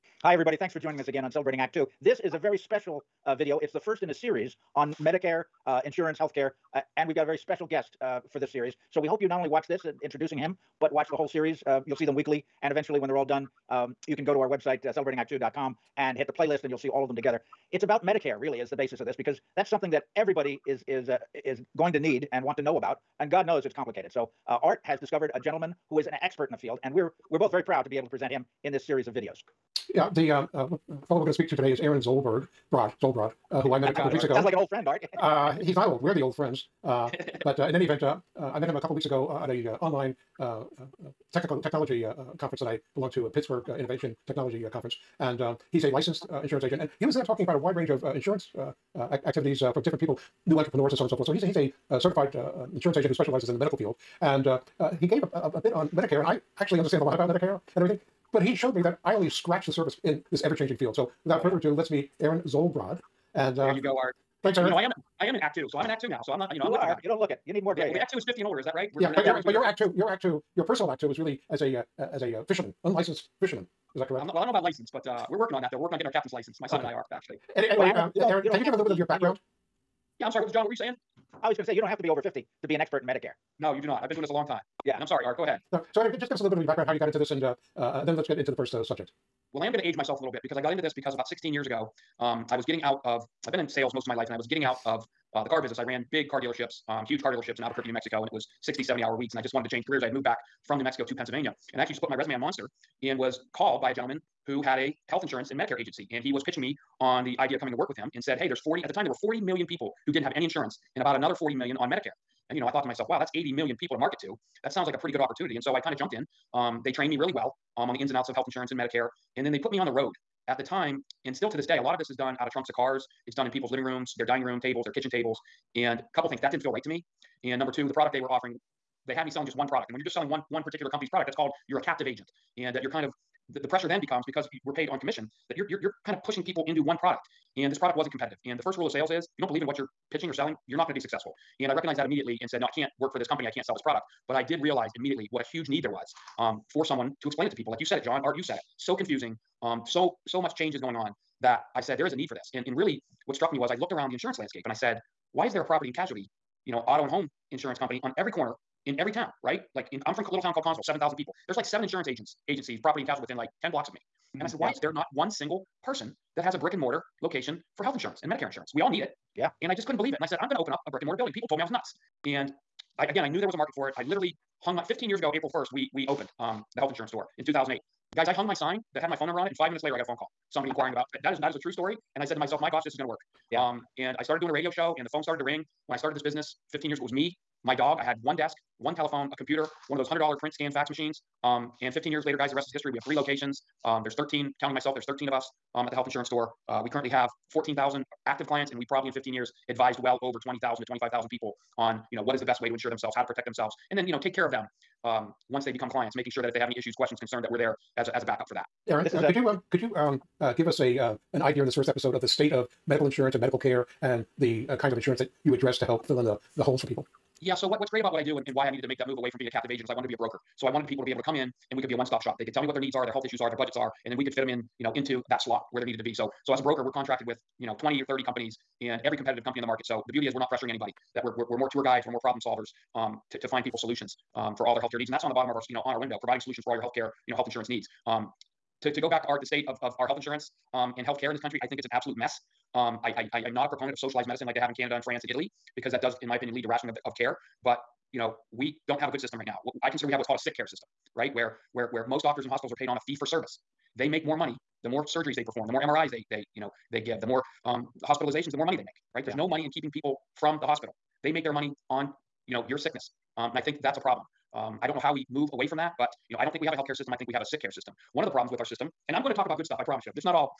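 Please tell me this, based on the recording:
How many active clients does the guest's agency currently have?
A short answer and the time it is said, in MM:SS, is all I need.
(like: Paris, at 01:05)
14,000, at 03:17.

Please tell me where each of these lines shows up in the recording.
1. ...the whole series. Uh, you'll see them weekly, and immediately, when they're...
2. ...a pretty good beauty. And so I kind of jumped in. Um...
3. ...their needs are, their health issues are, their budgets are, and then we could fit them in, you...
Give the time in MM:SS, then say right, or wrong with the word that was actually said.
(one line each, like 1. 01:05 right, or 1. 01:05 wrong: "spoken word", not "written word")
1. 00:11 wrong: "eventually", not "immediately"
2. 01:54 wrong: "opportunity", not "beauty"
3. 03:42 right.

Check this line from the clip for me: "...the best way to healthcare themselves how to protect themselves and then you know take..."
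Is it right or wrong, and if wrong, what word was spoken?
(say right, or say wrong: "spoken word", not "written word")
wrong: "insure", not "healthcare".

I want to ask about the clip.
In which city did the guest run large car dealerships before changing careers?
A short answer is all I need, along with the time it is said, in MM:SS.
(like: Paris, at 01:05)
Albuquerque, New Mexico, at 01:37.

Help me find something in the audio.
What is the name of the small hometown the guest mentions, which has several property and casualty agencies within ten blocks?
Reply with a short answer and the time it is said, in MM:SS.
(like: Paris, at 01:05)
Connellsville, at 02:40.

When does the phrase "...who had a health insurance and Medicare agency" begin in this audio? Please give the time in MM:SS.
01:44.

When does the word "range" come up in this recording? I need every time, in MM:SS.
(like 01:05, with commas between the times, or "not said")
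00:47.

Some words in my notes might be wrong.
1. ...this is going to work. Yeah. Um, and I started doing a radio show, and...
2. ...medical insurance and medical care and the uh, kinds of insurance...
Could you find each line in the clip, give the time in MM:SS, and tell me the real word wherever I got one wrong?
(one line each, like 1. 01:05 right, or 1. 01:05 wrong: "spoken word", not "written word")
1. 03:02 right
2. 03:32 right.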